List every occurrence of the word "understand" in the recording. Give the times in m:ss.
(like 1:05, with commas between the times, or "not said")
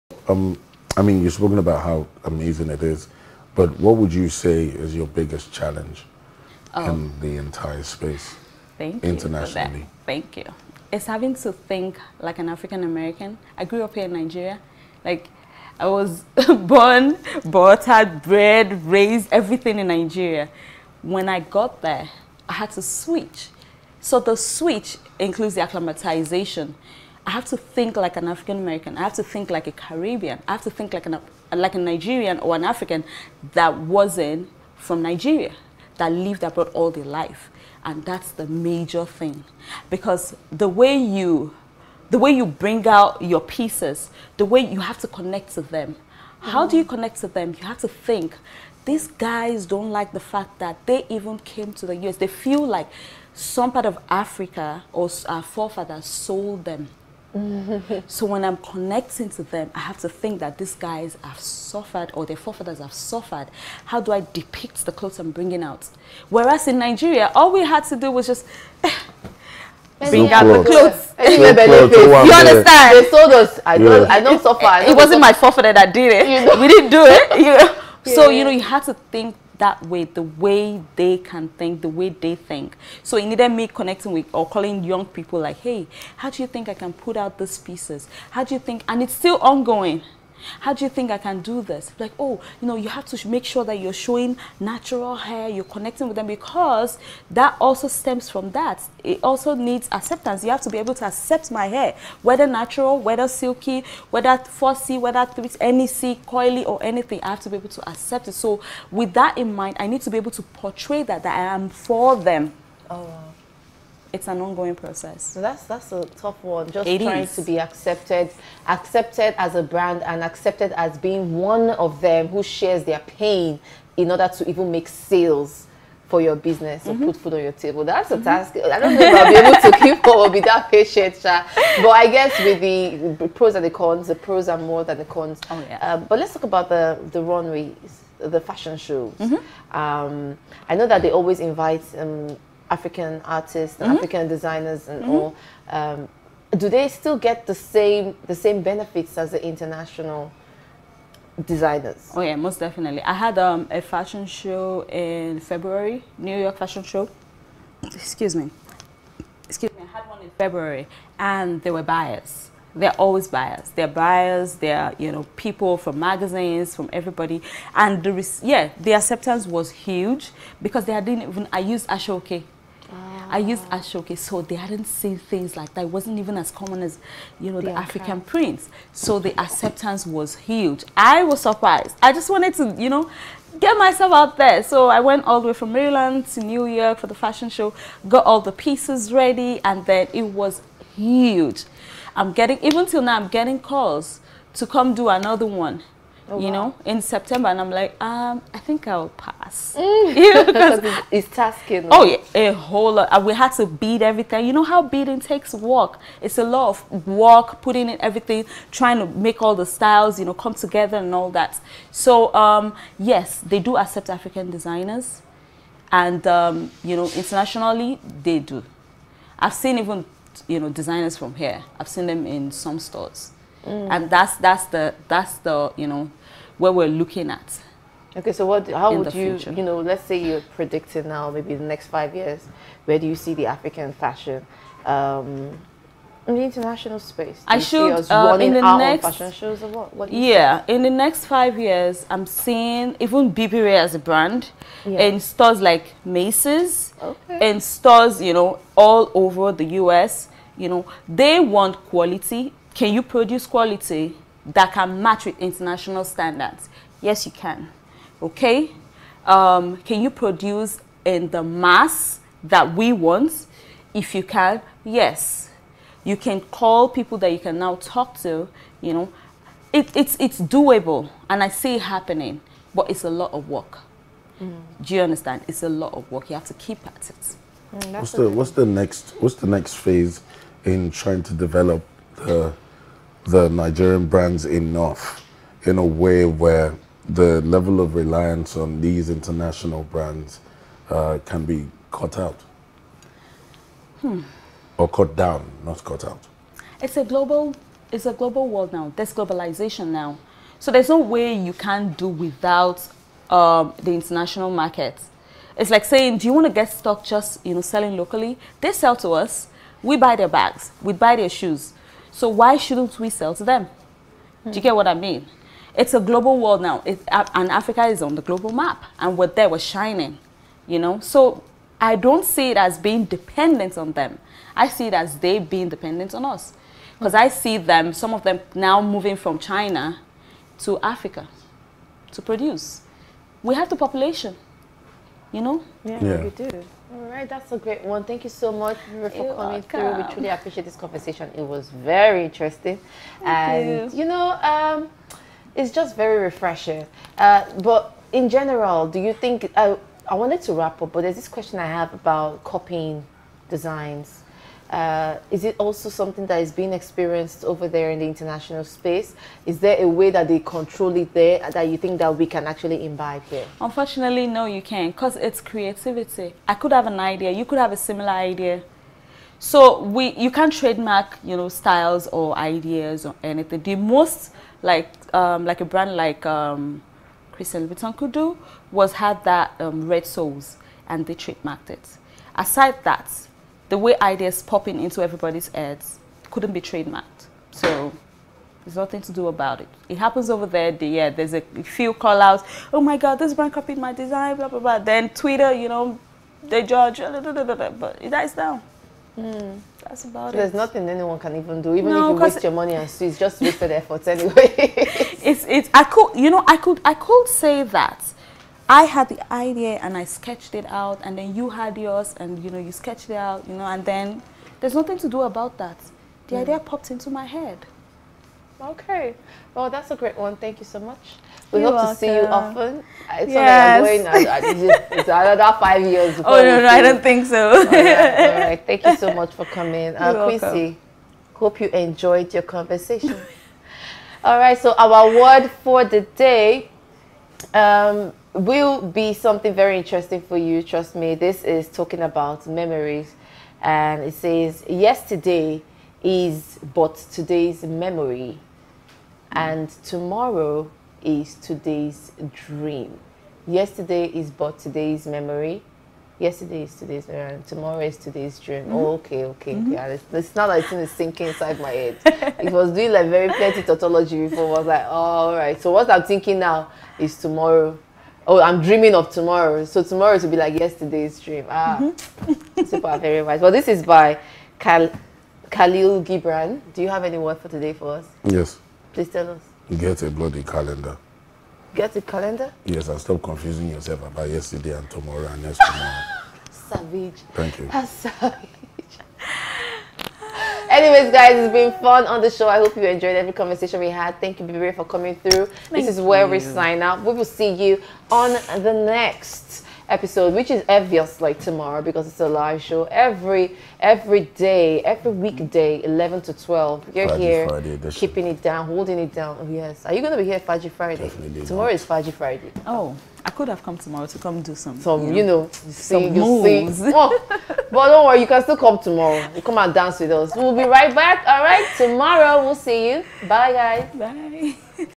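1:12, 4:35.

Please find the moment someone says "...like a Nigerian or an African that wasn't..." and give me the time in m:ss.
0:31.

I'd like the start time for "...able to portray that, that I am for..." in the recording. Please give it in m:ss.
1:50.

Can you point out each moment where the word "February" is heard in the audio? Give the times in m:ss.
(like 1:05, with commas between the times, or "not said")
2:35, 2:40.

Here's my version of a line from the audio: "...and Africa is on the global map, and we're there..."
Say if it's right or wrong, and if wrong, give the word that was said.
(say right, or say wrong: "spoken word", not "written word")
right.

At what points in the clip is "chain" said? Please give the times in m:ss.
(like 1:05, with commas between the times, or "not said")
not said.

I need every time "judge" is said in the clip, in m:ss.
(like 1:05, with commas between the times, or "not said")
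6:36.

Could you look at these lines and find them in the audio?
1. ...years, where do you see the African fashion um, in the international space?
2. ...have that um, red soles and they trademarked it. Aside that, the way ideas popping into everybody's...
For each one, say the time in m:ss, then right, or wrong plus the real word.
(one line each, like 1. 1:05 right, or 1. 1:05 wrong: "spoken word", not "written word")
1. 3:52 right
2. 6:18 right.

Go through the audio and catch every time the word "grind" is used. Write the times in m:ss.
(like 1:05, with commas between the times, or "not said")
not said.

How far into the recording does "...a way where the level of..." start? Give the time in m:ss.
4:45.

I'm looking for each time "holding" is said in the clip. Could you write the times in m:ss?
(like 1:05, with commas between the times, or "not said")
8:28.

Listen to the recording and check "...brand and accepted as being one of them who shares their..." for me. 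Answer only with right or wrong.
right.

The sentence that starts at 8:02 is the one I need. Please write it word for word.
Yes, and stop confusing yourself about yesterday and tomorrow and next tomorrow.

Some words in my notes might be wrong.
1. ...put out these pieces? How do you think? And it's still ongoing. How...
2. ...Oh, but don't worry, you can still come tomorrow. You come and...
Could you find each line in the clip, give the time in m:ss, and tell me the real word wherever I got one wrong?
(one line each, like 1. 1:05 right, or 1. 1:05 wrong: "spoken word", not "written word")
1. 1:26 right
2. 8:36 right.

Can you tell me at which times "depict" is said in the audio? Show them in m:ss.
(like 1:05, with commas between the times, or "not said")
1:04.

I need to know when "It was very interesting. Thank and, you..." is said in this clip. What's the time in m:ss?
5:41.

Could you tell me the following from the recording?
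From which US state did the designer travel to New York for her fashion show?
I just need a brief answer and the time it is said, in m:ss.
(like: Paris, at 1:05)
Maryland, at 3:05.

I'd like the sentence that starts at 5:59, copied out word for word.
Is there a way that they control it there that you think that we can actually imbibe here?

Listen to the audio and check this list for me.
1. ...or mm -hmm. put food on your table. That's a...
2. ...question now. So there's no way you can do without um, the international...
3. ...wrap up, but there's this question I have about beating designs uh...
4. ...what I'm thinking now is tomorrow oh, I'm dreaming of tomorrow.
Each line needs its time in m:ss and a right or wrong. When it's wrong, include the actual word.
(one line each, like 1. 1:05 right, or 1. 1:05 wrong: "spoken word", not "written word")
1. 2:06 right
2. 4:59 wrong: "globalization", not "question"
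3. 5:50 wrong: "copying", not "beating"
4. 7:45 right.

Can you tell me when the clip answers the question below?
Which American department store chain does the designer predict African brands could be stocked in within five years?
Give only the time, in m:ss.
4:05.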